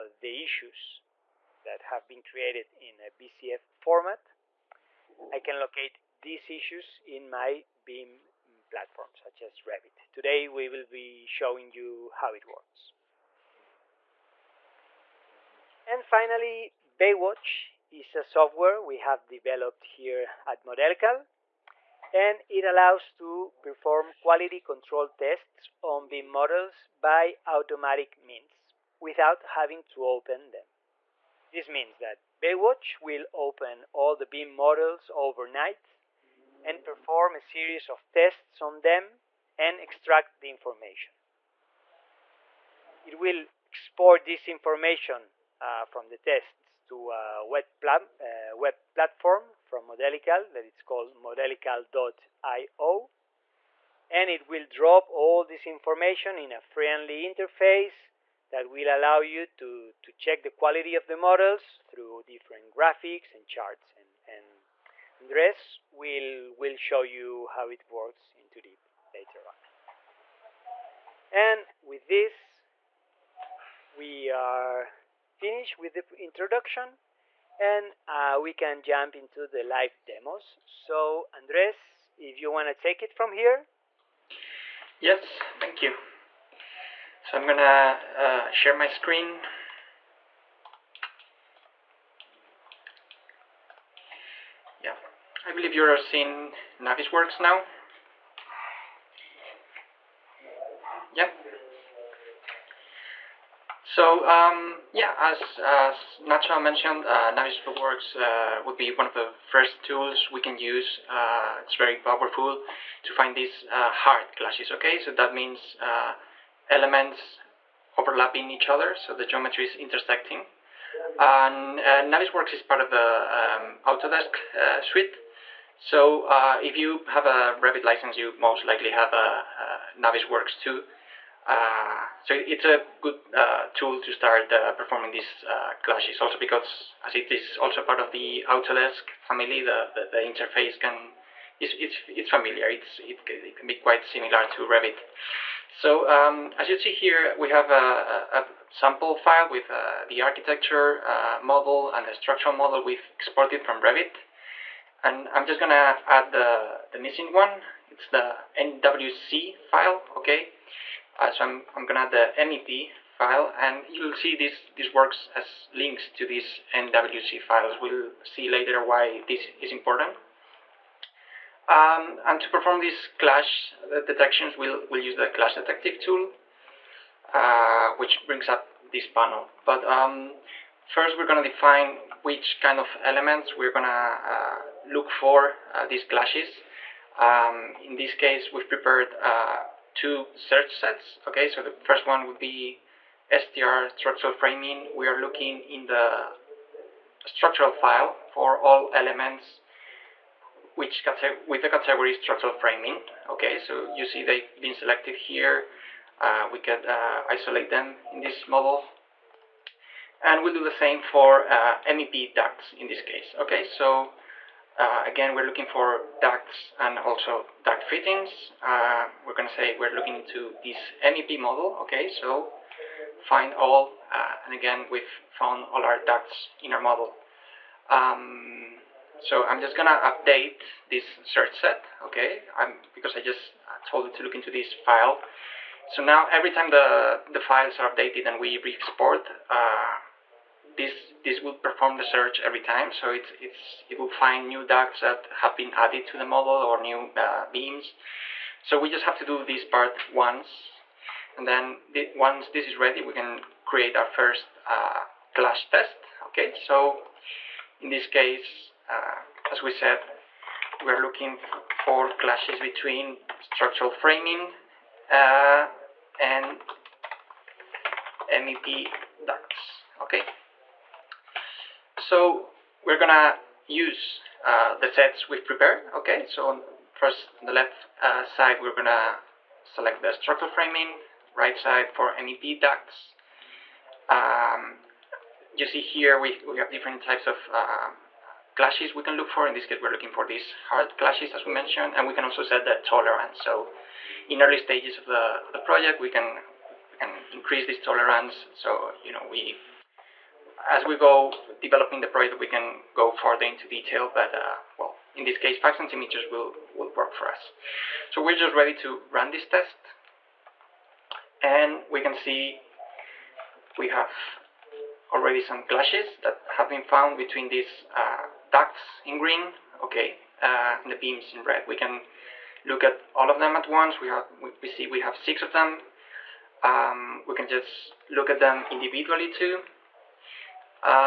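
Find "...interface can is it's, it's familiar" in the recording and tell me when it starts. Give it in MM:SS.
02:20.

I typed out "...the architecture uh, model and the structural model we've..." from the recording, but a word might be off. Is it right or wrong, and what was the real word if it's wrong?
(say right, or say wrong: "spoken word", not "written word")
right.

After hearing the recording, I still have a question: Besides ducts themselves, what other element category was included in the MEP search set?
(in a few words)
duct fittings.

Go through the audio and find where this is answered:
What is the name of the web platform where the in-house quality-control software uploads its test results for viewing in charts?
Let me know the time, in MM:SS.
00:51.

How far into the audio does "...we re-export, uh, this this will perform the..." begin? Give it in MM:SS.
03:58.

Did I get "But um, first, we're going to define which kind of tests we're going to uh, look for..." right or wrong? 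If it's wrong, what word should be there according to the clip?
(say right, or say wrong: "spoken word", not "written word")
wrong: "elements", not "tests".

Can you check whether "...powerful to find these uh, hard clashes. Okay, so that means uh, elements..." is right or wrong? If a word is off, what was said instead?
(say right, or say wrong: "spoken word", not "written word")
right.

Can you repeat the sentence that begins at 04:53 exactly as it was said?
So in early stages of the, the project, we can, we can increase this tolerance.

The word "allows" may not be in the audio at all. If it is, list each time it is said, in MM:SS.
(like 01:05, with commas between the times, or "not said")
00:22, 00:58.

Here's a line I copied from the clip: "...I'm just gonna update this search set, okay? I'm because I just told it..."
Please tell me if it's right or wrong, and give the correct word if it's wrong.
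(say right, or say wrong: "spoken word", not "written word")
right.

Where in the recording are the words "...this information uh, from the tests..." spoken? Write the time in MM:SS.
00:44.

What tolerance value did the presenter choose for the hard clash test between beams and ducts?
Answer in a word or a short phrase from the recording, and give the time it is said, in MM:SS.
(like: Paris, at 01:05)
5 centimeters, at 05:05.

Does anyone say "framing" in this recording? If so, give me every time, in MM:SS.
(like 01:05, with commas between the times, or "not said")
03:14, 03:22, 04:23, 04:40.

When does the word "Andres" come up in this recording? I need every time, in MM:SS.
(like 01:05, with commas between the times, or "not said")
01:05, 01:21.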